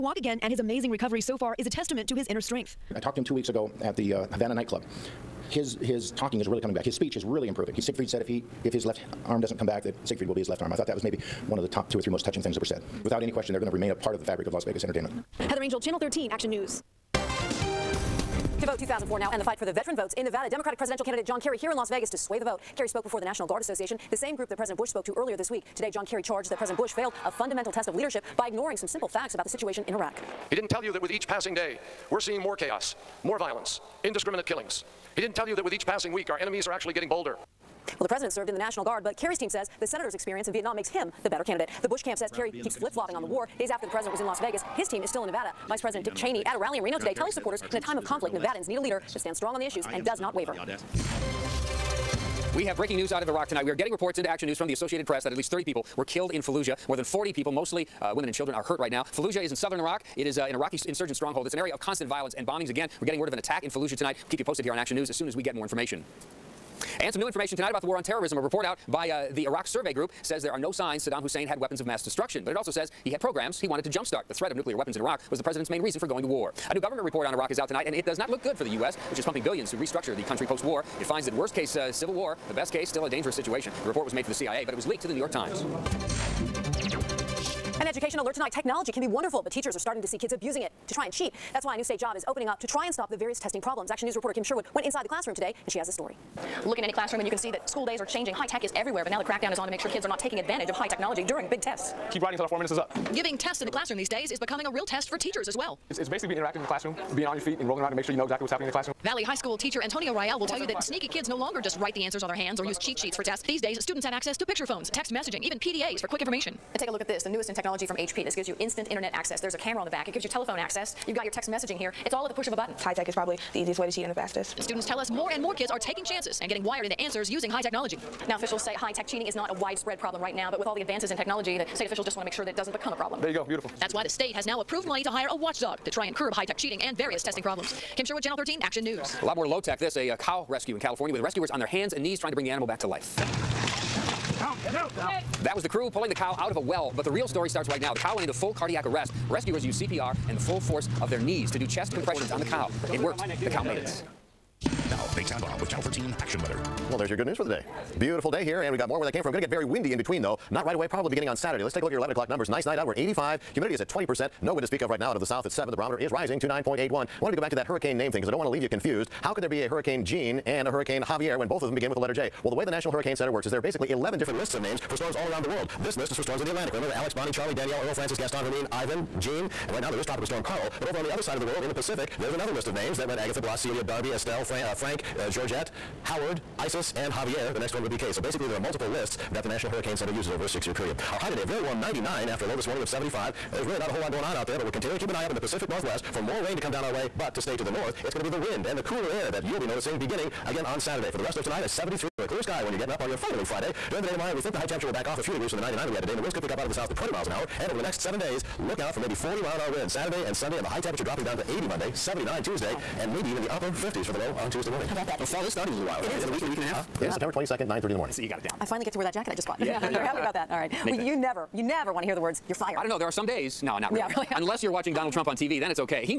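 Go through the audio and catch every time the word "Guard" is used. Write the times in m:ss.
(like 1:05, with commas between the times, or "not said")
0:23, 0:38.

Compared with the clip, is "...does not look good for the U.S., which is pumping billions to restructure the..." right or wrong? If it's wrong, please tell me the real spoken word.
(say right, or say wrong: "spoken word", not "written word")
right.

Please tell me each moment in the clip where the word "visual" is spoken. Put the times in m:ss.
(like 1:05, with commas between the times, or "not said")
not said.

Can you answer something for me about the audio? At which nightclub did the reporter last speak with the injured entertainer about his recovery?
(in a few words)
Havana.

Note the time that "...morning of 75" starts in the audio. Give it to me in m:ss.
3:12.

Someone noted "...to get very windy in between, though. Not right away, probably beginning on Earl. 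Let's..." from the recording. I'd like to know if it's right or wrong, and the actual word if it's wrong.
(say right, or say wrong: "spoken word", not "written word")
wrong: "Saturday", not "Earl".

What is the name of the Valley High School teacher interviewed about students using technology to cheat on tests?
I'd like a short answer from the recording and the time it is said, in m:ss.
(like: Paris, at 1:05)
Antonio Rial, at 1:49.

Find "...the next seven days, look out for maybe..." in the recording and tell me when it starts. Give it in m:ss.
3:27.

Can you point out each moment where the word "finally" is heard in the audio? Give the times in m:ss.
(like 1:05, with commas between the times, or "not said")
3:23, 3:38.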